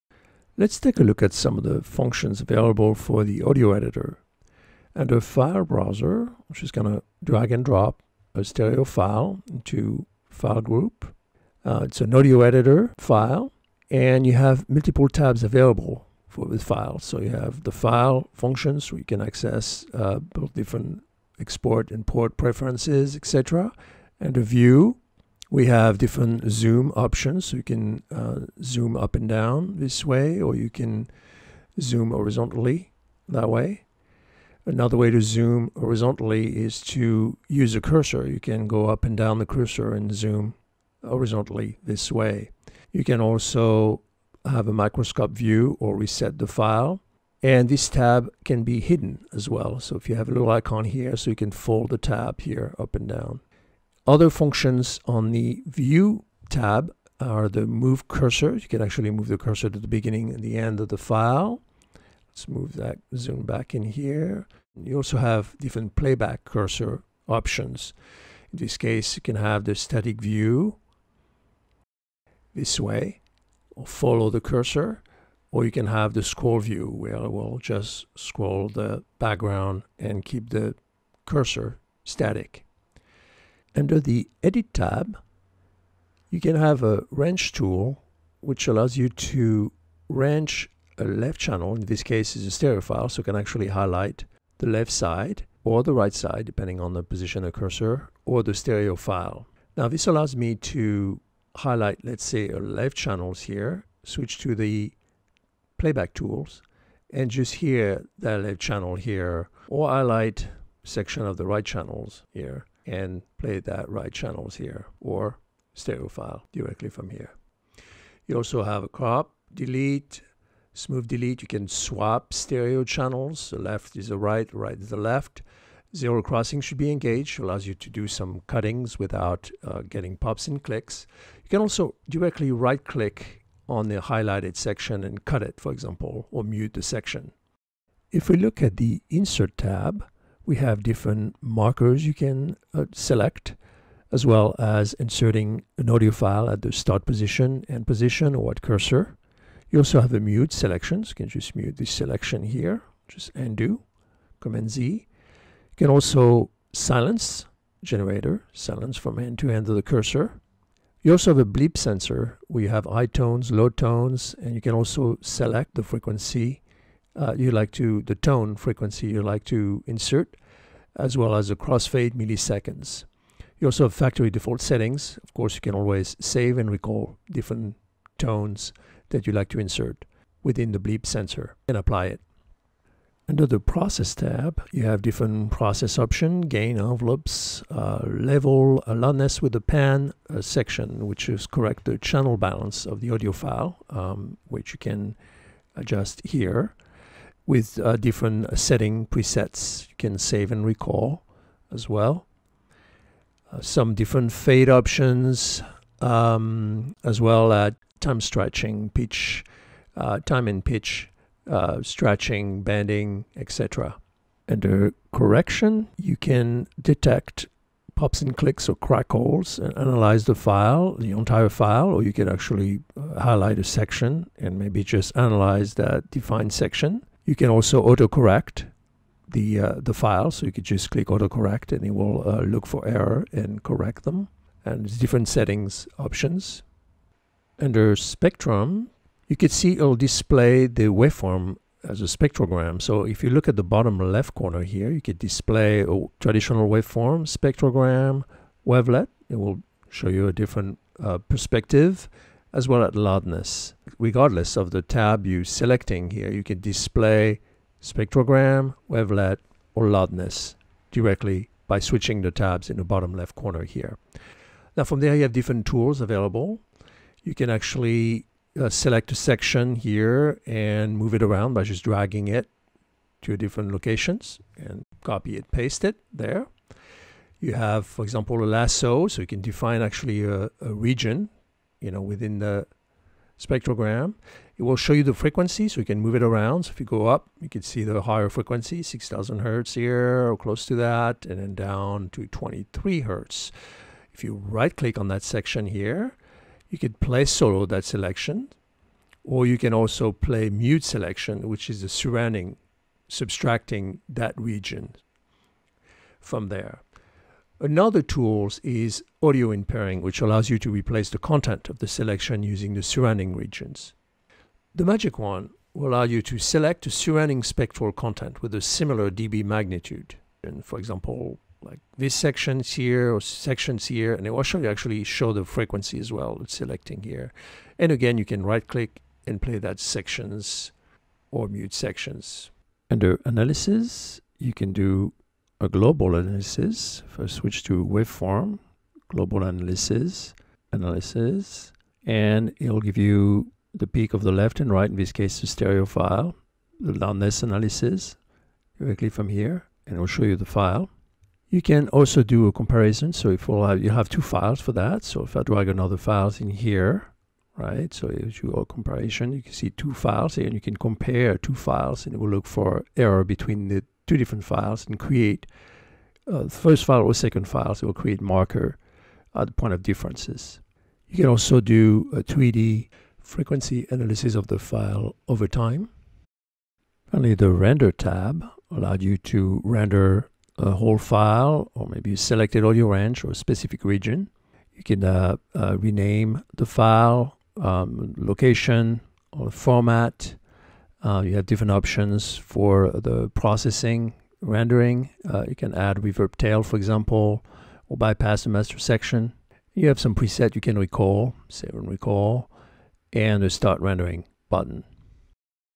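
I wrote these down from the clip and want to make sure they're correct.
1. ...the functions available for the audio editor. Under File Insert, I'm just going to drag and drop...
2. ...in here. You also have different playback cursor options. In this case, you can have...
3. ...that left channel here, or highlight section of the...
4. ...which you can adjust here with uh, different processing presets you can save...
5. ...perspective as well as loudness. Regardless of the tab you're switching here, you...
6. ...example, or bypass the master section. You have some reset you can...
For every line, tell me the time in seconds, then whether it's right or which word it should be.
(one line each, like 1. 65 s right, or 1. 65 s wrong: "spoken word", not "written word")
1. 1 s wrong: "Browser", not "Insert"
2. 63 s right
3. 108 s right
4. 194 s wrong: "setting", not "processing"
5. 251 s wrong: "selecting", not "switching"
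6. 396 s wrong: "preset", not "reset".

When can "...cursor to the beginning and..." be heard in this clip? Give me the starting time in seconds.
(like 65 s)
59 s.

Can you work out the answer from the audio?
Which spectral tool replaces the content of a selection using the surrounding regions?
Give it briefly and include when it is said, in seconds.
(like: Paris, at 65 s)
audio inpainting, at 309 s.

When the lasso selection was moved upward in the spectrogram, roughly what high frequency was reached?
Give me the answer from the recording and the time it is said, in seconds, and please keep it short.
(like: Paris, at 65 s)
6,000 hertz, at 288 s.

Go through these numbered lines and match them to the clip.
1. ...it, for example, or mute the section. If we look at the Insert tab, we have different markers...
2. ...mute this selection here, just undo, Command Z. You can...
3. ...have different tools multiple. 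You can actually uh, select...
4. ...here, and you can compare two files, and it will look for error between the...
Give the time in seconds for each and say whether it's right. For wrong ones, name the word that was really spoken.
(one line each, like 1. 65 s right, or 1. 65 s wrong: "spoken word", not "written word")
1. 135 s right
2. 151 s right
3. 265 s wrong: "available", not "multiple"
4. 360 s right.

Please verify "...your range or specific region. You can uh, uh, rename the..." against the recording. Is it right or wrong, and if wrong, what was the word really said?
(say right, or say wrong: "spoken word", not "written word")
right.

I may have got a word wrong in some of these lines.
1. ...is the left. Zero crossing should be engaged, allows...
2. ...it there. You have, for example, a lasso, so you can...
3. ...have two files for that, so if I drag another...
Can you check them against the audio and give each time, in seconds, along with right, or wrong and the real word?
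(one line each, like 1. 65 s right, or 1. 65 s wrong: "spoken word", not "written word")
1. 124 s right
2. 275 s right
3. 353 s right.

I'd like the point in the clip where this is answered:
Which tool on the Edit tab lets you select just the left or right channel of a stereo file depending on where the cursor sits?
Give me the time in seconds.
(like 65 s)
87 s.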